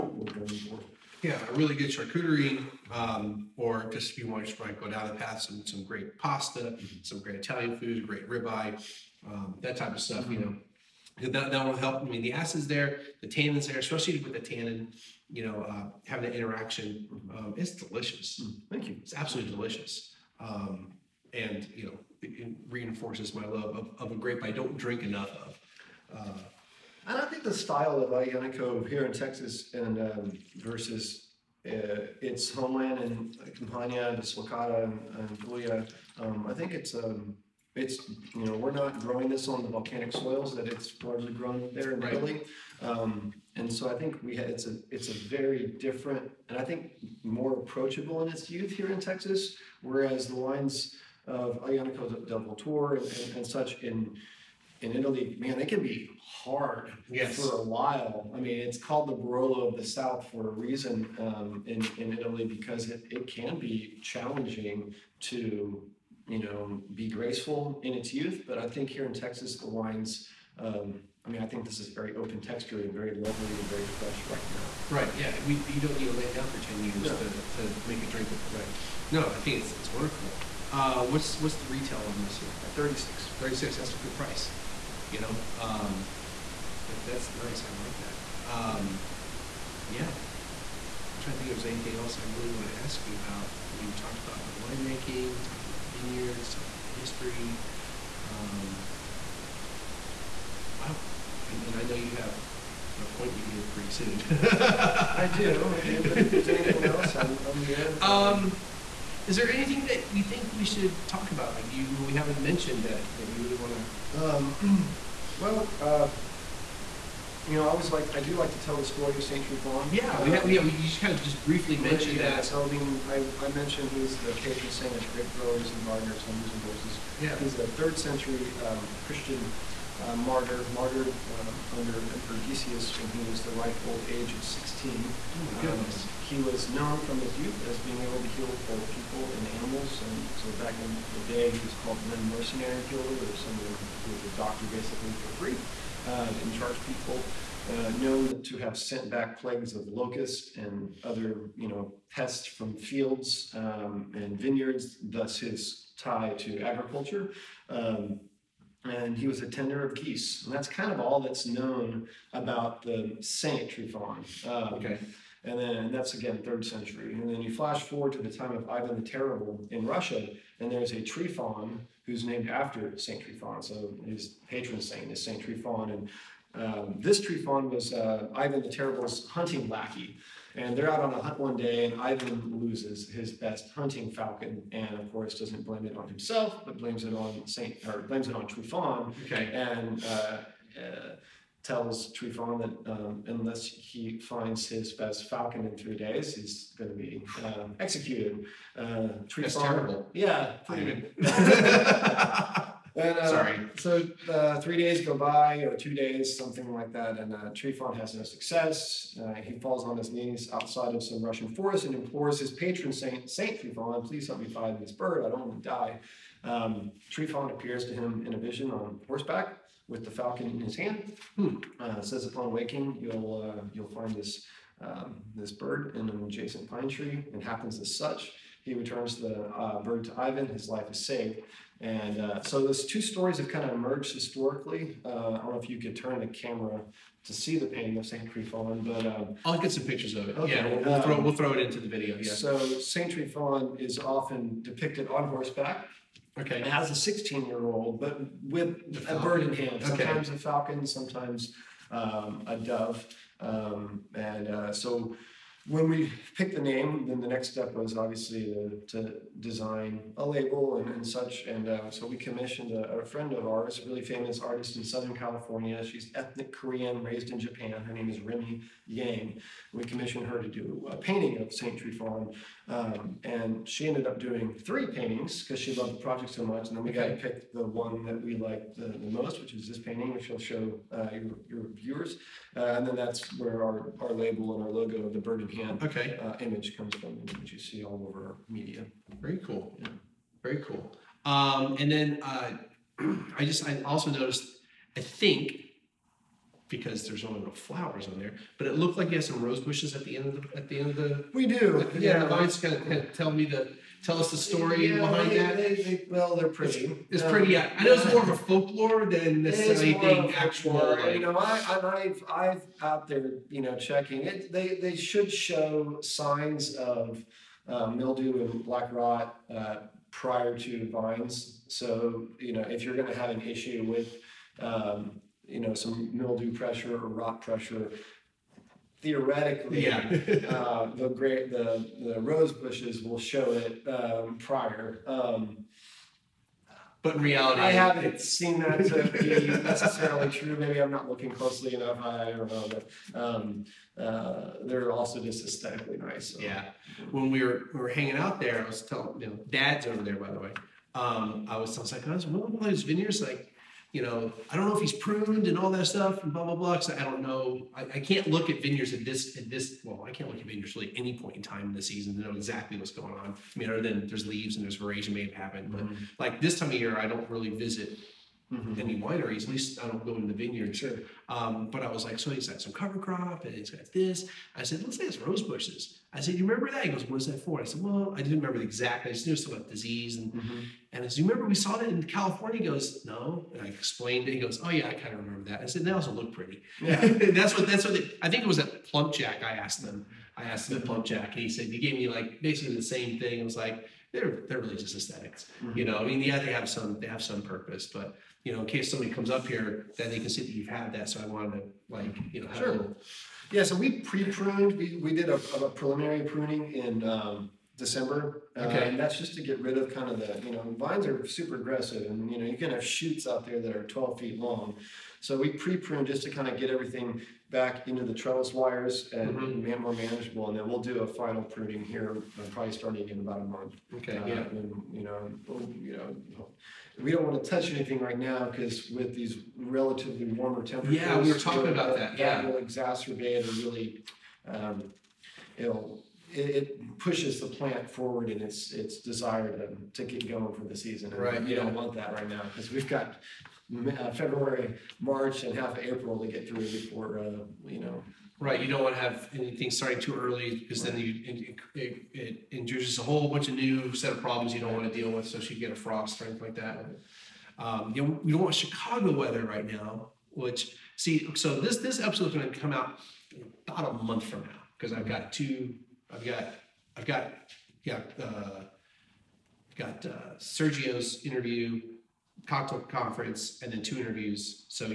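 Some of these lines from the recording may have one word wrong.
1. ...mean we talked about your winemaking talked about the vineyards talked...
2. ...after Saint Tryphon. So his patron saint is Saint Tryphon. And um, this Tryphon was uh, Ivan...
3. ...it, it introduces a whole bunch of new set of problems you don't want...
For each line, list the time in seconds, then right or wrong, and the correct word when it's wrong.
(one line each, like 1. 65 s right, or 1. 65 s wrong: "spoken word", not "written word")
1. 93 s right
2. 172 s right
3. 451 s right.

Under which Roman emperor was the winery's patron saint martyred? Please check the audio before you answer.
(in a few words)
Decius.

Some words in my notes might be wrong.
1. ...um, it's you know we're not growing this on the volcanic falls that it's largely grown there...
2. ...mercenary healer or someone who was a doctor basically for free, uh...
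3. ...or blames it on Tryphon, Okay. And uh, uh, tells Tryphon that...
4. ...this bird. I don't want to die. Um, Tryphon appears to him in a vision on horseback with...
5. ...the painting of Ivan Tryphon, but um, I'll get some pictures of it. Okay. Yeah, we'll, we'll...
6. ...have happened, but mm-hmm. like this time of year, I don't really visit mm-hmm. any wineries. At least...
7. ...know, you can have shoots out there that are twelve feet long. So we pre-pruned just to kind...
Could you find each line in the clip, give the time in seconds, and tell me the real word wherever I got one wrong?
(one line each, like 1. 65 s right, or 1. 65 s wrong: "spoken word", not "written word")
1. 36 s wrong: "soils", not "falls"
2. 142 s right
3. 187 s right
4. 214 s right
5. 237 s wrong: "Saint", not "Ivan"
6. 365 s right
7. 412 s right.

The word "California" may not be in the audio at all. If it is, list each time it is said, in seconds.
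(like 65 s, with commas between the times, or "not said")
265 s, 382 s.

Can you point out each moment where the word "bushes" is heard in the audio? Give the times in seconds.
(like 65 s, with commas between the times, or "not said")
299 s, 332 s, 375 s.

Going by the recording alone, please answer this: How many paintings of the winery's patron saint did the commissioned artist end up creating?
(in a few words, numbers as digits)
3.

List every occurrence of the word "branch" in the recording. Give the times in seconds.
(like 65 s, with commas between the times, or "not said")
not said.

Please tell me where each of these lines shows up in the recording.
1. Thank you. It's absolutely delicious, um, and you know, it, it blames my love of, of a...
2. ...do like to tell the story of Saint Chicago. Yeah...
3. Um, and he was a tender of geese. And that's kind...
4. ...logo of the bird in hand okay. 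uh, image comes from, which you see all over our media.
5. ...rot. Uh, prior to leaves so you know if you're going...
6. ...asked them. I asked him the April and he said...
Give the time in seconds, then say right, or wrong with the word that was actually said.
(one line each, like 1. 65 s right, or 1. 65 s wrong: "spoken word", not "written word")
1. 18 s wrong: "reinforces", not "blames"
2. 118 s wrong: "Tryphon", not "Chicago"
3. 157 s right
4. 284 s right
5. 318 s wrong: "vines", not "leaves"
6. 389 s wrong: "PlumpJack", not "April".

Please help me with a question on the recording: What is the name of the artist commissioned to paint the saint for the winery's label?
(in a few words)
Remy Yang.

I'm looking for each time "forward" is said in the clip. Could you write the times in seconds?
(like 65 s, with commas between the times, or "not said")
167 s, 437 s.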